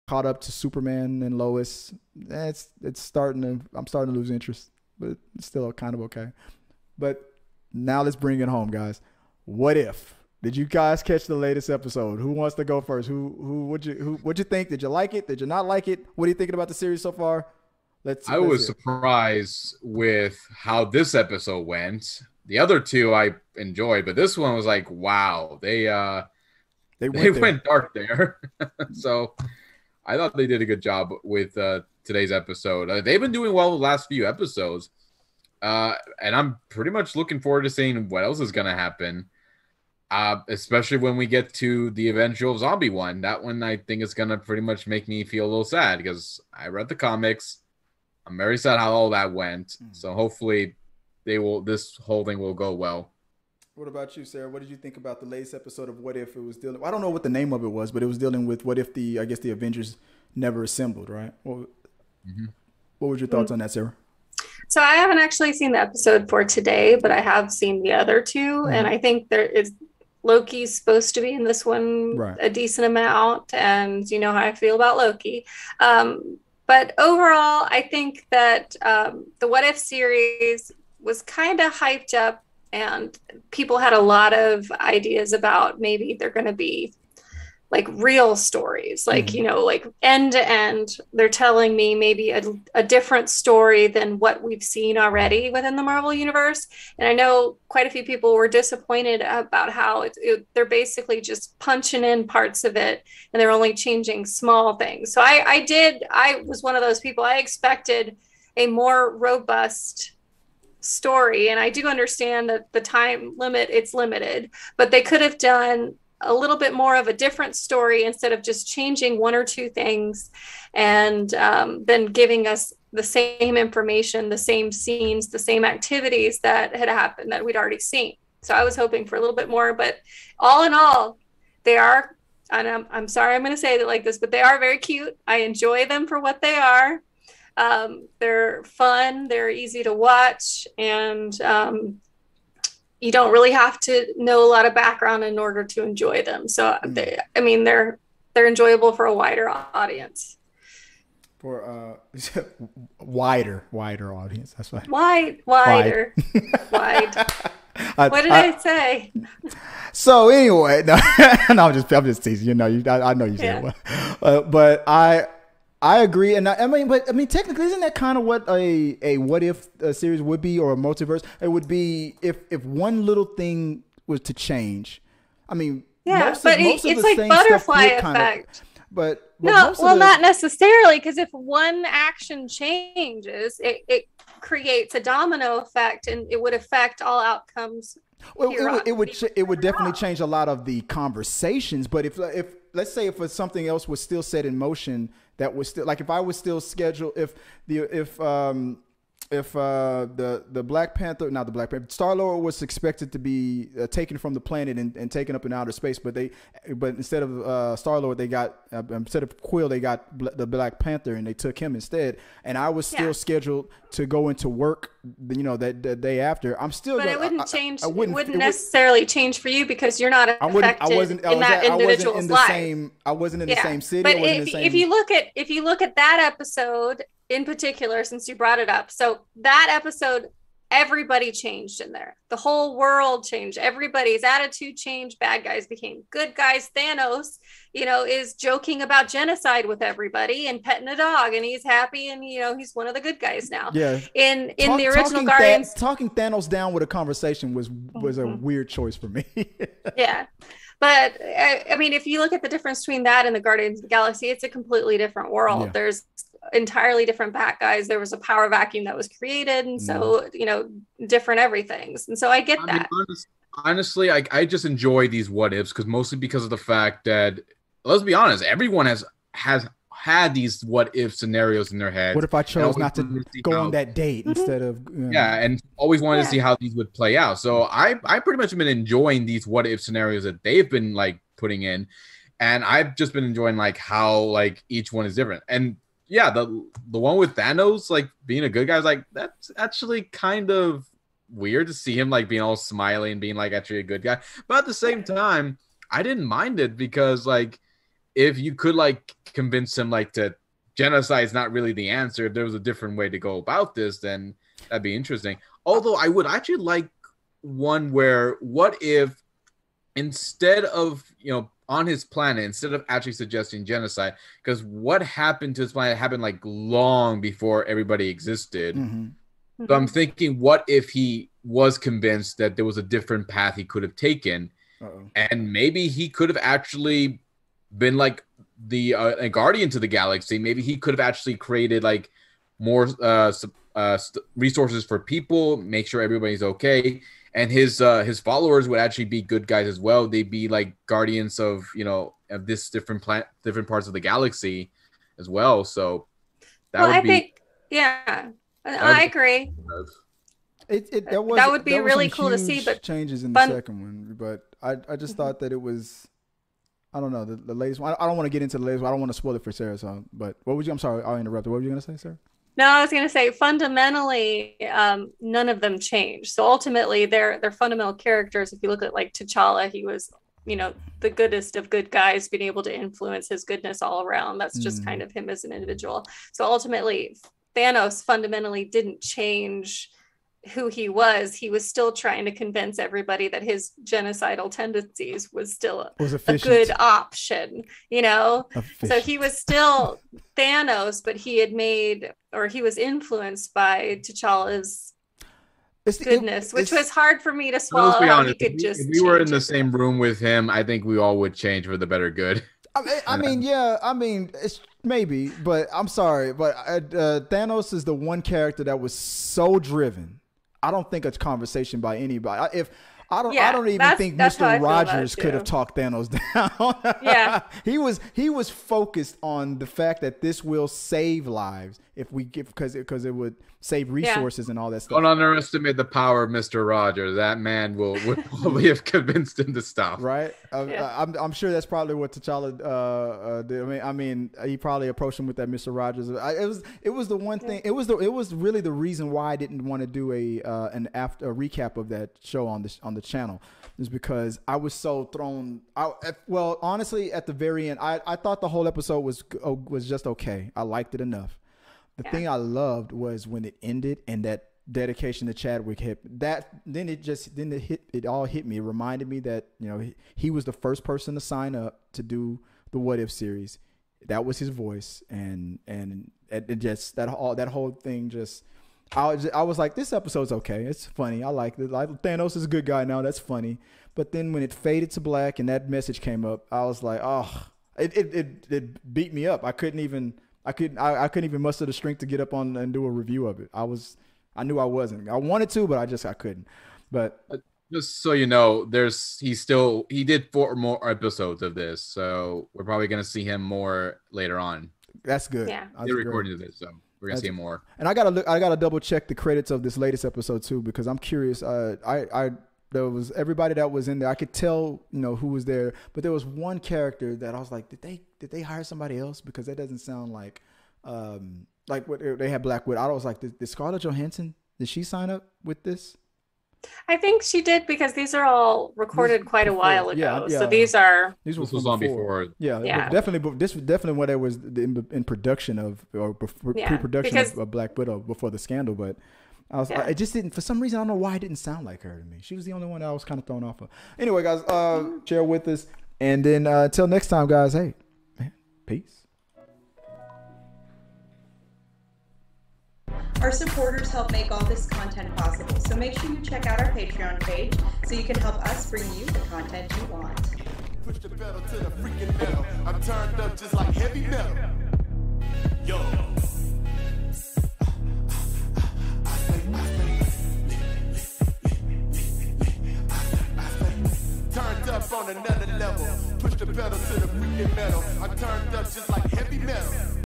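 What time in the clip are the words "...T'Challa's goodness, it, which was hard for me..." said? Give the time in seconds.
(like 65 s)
394 s.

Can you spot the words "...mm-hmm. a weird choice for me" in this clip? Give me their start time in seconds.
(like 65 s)
248 s.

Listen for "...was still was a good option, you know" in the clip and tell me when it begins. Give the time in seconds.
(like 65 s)
385 s.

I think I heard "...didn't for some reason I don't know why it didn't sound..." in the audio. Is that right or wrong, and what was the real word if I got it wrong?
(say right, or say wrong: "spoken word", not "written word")
right.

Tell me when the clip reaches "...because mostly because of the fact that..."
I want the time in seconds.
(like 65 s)
265 s.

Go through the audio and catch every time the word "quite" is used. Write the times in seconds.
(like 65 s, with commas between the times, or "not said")
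97 s, 519 s.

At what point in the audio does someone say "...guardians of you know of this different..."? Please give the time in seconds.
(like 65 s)
340 s.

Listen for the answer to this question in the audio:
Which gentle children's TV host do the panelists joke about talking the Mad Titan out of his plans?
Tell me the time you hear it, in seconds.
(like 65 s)
414 s.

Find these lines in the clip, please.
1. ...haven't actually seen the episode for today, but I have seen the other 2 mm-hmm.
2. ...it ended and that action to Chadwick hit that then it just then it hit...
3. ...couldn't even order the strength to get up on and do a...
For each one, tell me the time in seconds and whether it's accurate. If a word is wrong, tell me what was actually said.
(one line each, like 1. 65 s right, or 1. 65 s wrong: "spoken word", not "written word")
1. 64 s right
2. 453 s wrong: "dedication", not "action"
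3. 481 s wrong: "muster", not "order".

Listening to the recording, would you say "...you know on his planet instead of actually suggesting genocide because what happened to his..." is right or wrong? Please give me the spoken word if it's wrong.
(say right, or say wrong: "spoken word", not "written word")
right.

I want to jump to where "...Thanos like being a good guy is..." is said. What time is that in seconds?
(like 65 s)
287 s.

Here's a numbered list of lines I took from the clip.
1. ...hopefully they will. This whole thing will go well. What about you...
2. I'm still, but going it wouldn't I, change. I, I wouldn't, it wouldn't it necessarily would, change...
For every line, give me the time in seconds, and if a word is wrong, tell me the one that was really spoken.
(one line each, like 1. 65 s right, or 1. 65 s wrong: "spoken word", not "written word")
1. 50 s right
2. 216 s right.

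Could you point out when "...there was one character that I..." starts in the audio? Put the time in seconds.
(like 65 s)
506 s.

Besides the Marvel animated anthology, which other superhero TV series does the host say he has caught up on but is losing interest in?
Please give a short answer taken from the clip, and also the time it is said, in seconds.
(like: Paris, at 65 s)
Superman and Lois, at 0 s.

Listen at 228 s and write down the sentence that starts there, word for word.
So that episode, everybody changed in there.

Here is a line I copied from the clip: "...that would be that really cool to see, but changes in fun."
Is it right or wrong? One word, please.
right.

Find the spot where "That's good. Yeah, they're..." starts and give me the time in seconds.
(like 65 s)
495 s.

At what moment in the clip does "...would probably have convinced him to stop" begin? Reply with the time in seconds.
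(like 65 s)
428 s.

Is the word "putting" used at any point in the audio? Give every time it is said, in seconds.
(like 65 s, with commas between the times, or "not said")
281 s.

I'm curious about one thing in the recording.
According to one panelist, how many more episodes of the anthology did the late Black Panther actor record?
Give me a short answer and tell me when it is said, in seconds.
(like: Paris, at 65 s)
4, at 490 s.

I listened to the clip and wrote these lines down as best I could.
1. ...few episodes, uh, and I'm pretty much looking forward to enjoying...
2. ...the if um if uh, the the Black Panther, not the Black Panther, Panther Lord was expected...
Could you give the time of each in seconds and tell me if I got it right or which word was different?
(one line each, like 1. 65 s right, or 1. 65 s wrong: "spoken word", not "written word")
1. 34 s wrong: "seeing", not "enjoying"
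2. 197 s wrong: "Star", not "Panther".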